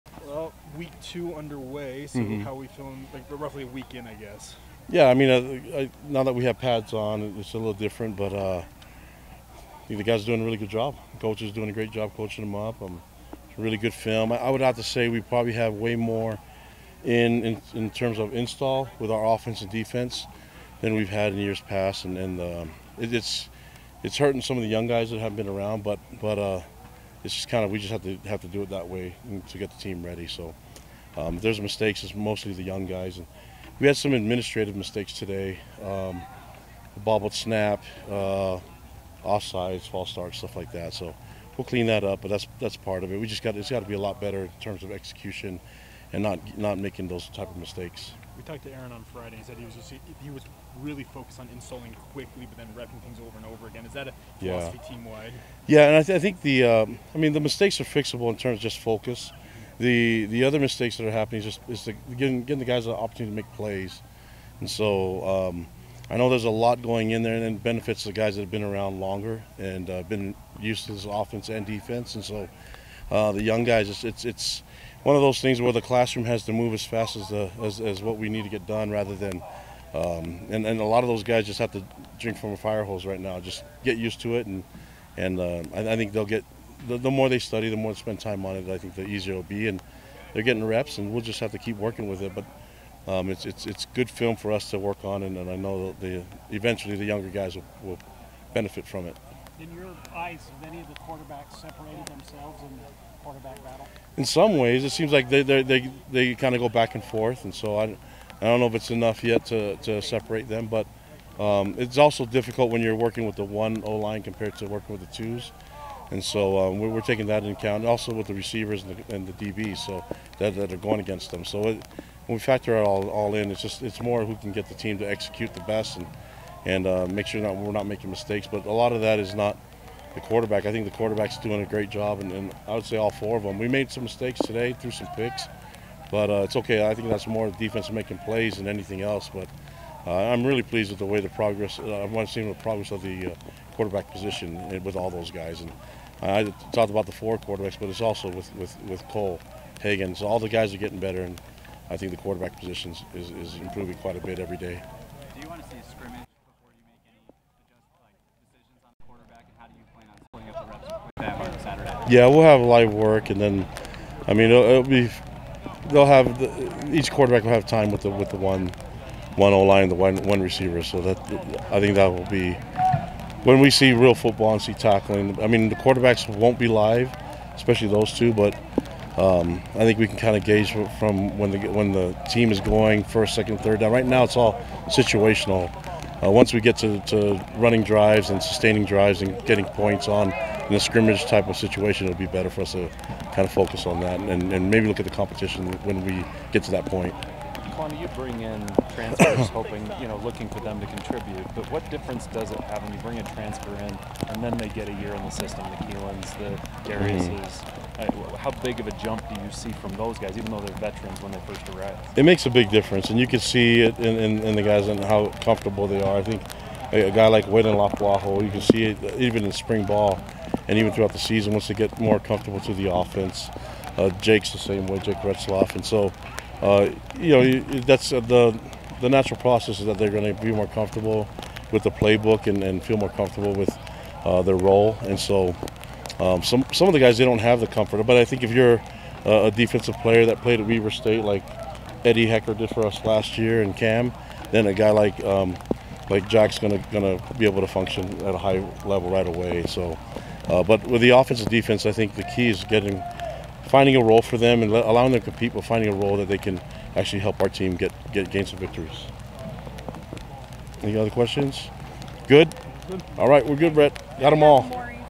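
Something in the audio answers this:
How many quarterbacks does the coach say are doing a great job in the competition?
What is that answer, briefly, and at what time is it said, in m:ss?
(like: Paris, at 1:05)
4, at 2:12.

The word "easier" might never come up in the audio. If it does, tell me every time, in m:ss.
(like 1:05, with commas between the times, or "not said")
1:29.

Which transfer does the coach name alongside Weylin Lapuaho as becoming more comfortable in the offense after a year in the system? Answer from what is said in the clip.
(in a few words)
Jake Retzloff.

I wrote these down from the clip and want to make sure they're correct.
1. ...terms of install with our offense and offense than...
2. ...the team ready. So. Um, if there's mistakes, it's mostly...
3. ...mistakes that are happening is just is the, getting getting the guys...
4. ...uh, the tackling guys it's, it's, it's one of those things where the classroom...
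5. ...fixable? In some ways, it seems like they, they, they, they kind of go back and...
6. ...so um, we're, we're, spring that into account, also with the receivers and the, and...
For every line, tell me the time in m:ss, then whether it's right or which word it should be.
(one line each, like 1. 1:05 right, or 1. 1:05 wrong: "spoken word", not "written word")
1. 0:17 wrong: "defense", not "offense"
2. 0:29 right
3. 1:00 right
4. 1:13 wrong: "young", not "tackling"
5. 1:43 wrong: "battle", not "fixable"
6. 1:56 wrong: "taking", not "spring".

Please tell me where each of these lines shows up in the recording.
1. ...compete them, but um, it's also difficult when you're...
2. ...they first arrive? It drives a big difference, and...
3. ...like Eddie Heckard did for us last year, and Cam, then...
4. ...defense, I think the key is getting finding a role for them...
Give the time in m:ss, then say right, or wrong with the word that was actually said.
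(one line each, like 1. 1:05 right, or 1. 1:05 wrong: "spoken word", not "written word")
1. 1:50 wrong: "separate", not "compete"
2. 3:31 wrong: "makes", not "drives"
3. 4:01 right
4. 4:11 right.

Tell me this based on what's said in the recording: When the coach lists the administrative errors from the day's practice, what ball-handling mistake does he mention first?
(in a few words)
Bobbled snap.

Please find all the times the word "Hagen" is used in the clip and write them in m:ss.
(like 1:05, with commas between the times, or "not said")
2:29.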